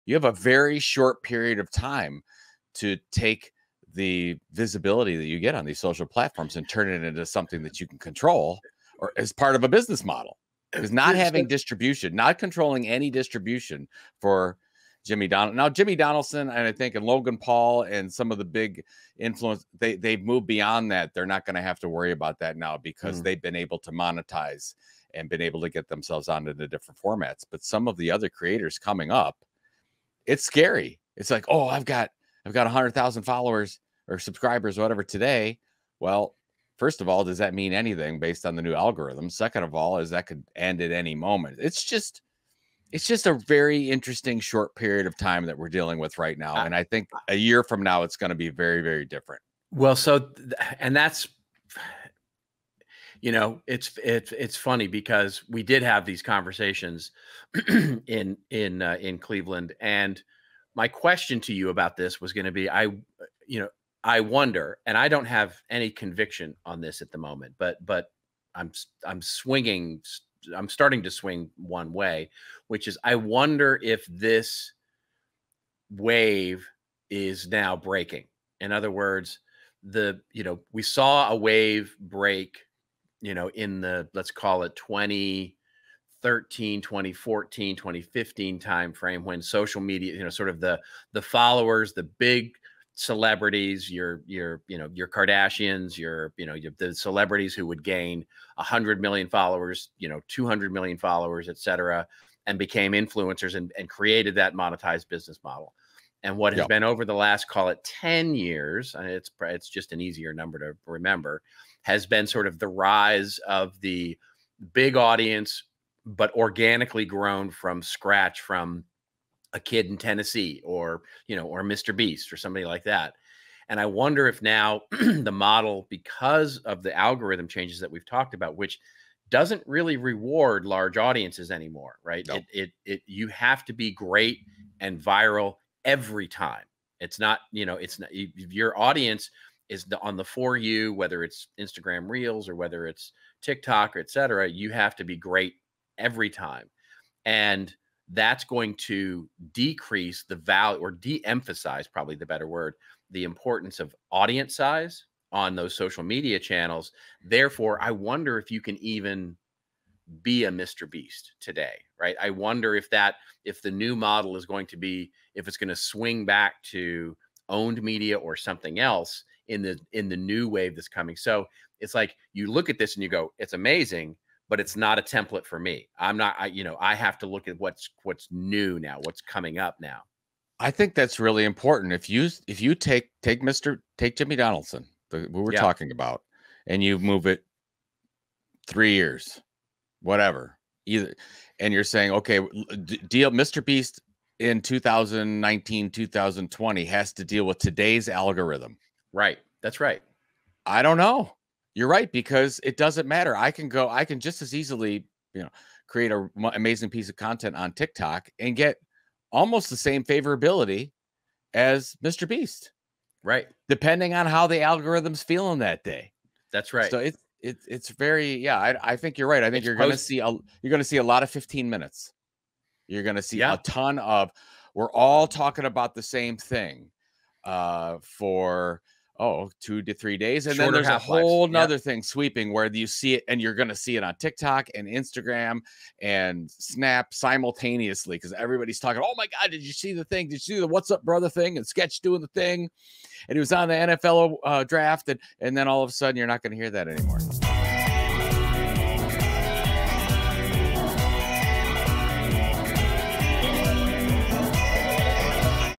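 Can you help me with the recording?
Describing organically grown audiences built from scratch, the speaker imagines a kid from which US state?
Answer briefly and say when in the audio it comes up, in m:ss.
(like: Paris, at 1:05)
Tennessee, at 1:59.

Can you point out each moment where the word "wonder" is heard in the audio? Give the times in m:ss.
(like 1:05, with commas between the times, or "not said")
1:04, 1:13, 2:03, 2:37, 2:42.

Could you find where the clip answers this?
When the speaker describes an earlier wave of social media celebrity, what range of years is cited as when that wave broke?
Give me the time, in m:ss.
1:24.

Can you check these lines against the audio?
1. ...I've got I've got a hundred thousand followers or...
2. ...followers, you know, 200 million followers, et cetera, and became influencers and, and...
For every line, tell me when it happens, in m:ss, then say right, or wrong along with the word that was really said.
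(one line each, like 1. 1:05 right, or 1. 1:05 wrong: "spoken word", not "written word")
1. 0:31 right
2. 1:39 right.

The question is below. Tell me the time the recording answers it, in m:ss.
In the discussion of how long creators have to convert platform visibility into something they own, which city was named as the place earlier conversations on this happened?
0:59.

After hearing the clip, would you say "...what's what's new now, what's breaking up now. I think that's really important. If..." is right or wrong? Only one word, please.
wrong.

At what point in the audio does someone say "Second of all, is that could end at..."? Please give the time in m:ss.
0:39.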